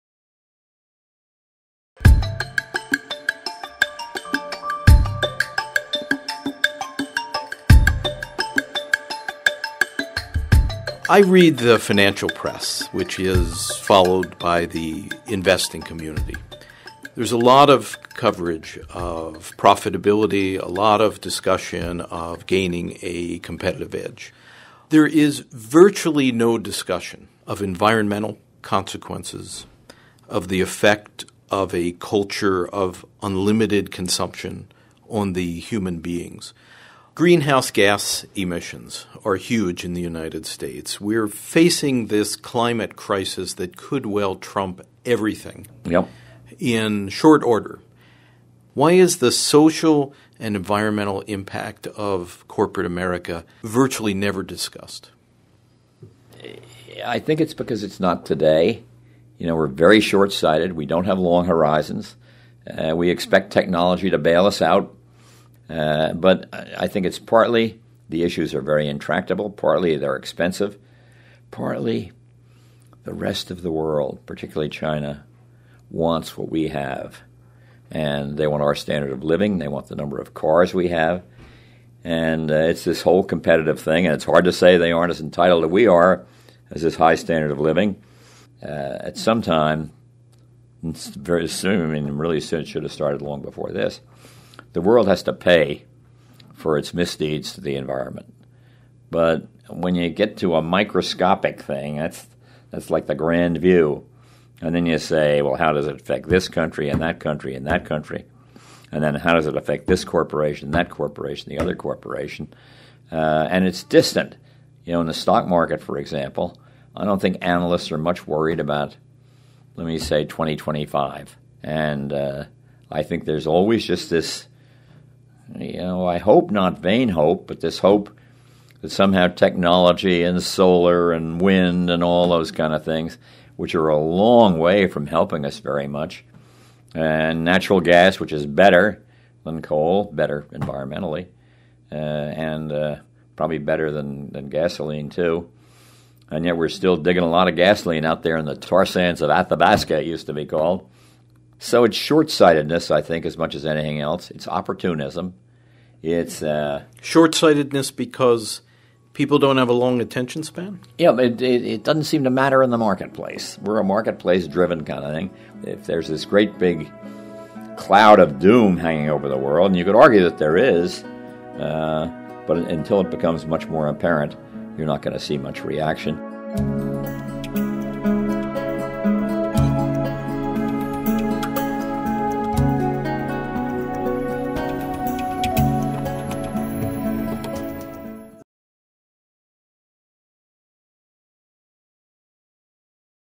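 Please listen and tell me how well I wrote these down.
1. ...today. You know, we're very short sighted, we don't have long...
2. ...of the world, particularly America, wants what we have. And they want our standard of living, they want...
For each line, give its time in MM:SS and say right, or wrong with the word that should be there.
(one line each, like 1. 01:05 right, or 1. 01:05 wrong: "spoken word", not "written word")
1. 00:58 right
2. 01:13 wrong: "China", not "America".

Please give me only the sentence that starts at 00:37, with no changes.
Greenhouse gas emissions are huge in the United States.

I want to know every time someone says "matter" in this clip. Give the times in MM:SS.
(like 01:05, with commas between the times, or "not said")
02:42.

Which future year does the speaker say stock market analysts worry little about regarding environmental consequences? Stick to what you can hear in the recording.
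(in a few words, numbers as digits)
2025.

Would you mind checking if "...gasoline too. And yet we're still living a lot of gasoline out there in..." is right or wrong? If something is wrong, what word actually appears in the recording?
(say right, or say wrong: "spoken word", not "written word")
wrong: "digging", not "living".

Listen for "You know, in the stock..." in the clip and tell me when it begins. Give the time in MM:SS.
01:54.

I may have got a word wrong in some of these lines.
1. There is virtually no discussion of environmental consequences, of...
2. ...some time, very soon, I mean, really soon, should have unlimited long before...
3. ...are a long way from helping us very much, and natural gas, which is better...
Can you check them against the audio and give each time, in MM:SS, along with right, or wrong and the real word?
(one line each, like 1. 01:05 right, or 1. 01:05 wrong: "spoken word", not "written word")
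1. 00:24 right
2. 01:29 wrong: "started", not "unlimited"
3. 02:13 right.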